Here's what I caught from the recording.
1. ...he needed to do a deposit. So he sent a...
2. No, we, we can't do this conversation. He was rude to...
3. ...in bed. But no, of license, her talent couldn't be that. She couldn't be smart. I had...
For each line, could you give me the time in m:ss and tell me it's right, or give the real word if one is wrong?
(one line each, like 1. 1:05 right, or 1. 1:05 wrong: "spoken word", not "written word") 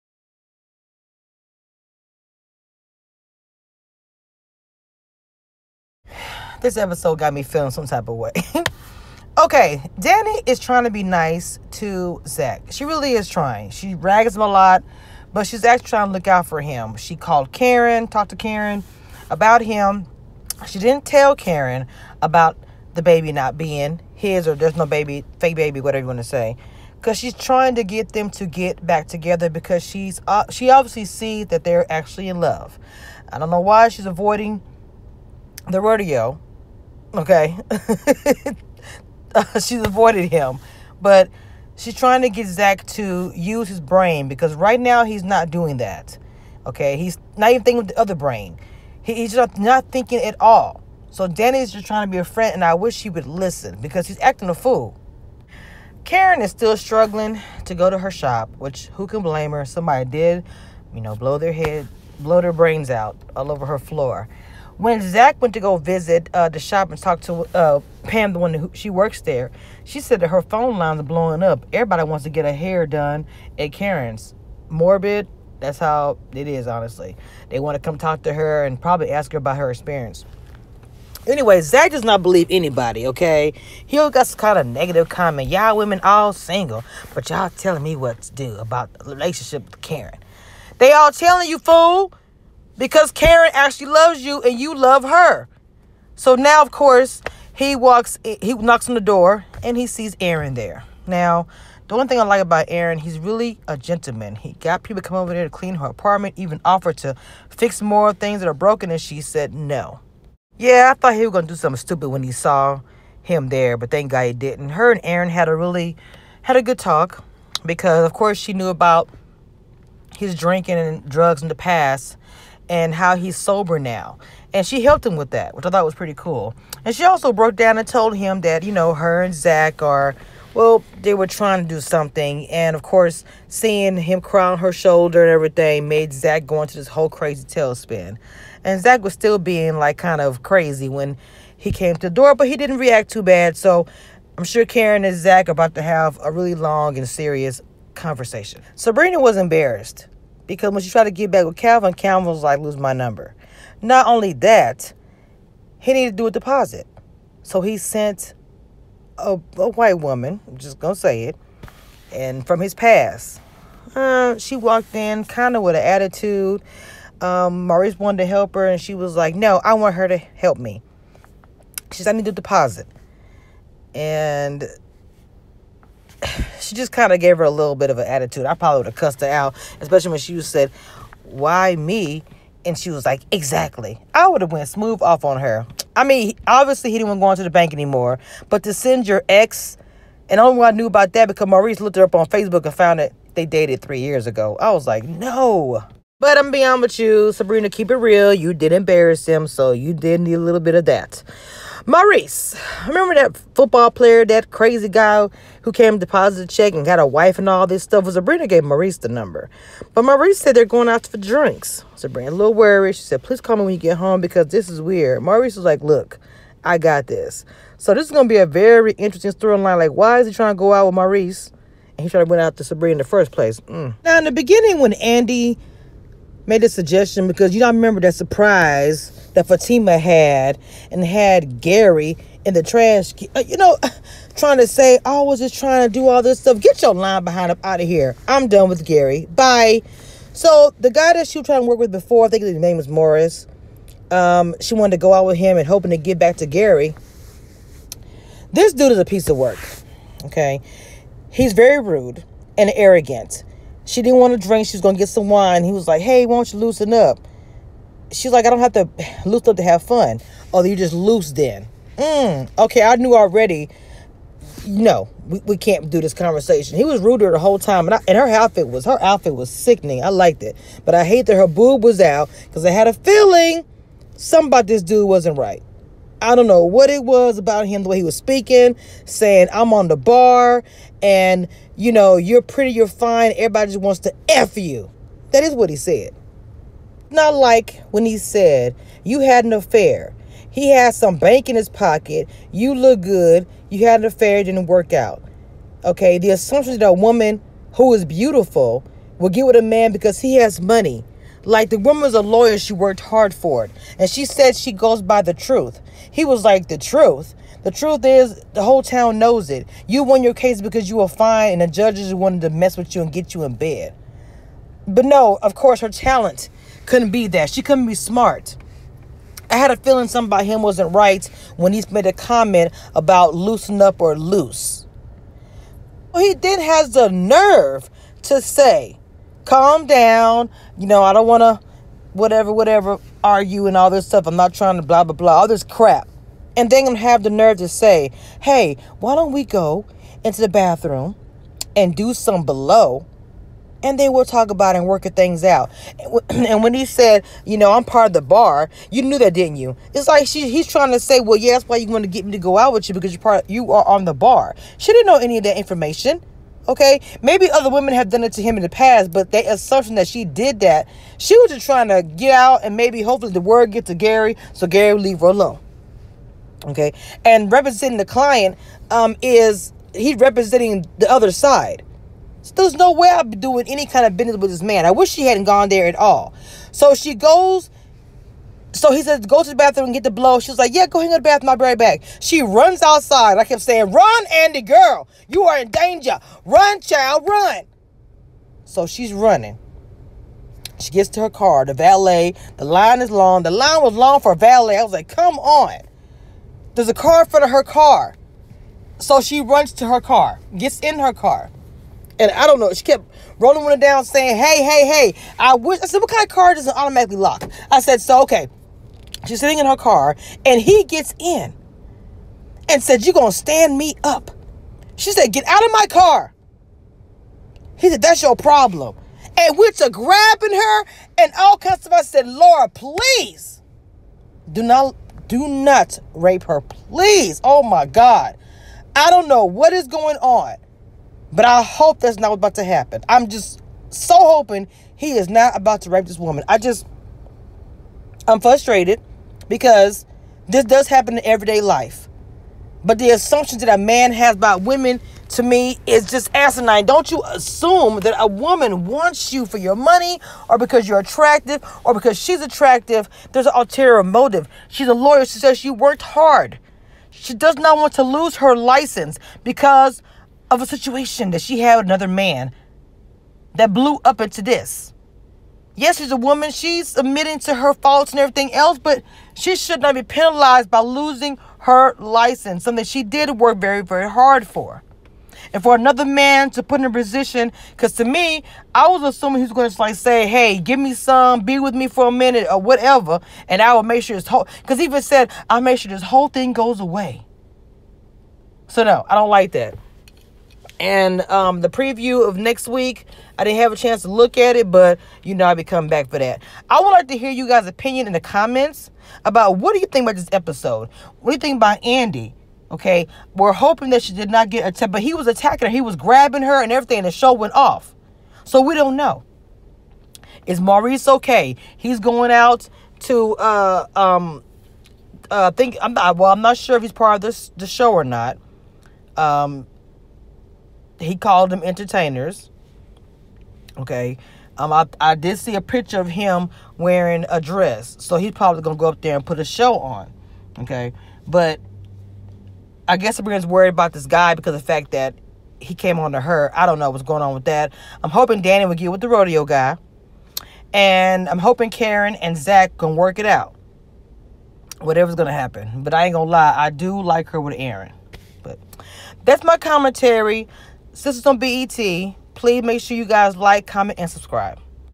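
1. 2:35 right
2. 4:24 right
3. 5:13 wrong: "course", not "license".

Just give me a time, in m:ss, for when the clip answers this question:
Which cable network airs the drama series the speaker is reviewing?
9:11.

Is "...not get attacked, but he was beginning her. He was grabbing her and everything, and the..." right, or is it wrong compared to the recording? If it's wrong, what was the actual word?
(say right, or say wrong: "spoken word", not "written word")
wrong: "attacking", not "beginning".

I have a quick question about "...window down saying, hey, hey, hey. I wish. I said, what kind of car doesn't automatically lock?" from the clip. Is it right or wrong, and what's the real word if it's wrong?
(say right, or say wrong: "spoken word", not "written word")
right.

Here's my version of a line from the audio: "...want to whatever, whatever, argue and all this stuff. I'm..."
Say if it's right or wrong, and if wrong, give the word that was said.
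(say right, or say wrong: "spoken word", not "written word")
right.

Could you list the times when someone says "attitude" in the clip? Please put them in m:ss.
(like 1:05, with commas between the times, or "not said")
2:45, 2:58.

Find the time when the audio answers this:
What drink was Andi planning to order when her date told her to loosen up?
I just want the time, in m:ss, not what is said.
4:15.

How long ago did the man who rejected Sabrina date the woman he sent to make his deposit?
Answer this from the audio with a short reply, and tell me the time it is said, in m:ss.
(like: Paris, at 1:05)
3 years, at 3:13.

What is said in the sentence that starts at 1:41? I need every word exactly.
Now, the one thing I like about Aaron, he's really a gentleman.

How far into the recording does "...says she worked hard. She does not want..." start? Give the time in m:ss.
7:35.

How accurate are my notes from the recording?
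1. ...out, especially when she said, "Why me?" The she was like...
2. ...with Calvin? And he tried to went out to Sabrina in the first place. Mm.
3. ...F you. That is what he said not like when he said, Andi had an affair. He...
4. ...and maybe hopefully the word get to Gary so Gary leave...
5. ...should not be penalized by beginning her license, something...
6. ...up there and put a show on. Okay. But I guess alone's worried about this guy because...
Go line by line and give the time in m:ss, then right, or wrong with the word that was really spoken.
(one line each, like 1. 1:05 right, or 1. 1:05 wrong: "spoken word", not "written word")
1. 2:59 wrong: "And", not "The"
2. 3:40 wrong: "Maurice", not "Calvin"
3. 4:44 wrong: "You", not "Andi"
4. 6:02 right
5. 7:49 wrong: "losing", not "beginning"
6. 8:48 wrong: "everyone", not "alone".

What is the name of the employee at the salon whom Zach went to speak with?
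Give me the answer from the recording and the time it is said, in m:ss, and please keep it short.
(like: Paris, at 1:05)
Pam, at 1:08.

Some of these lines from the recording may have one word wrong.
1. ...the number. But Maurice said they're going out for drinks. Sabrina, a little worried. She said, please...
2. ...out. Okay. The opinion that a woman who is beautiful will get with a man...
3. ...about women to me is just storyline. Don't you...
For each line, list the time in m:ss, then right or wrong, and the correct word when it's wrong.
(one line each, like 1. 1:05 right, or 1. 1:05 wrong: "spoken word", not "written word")
1. 3:28 right
2. 4:54 wrong: "assumption", not "opinion"
3. 7:24 wrong: "asinine", not "storyline".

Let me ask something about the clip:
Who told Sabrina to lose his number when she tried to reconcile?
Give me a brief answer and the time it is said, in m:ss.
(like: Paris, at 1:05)
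Calvin, at 2:31.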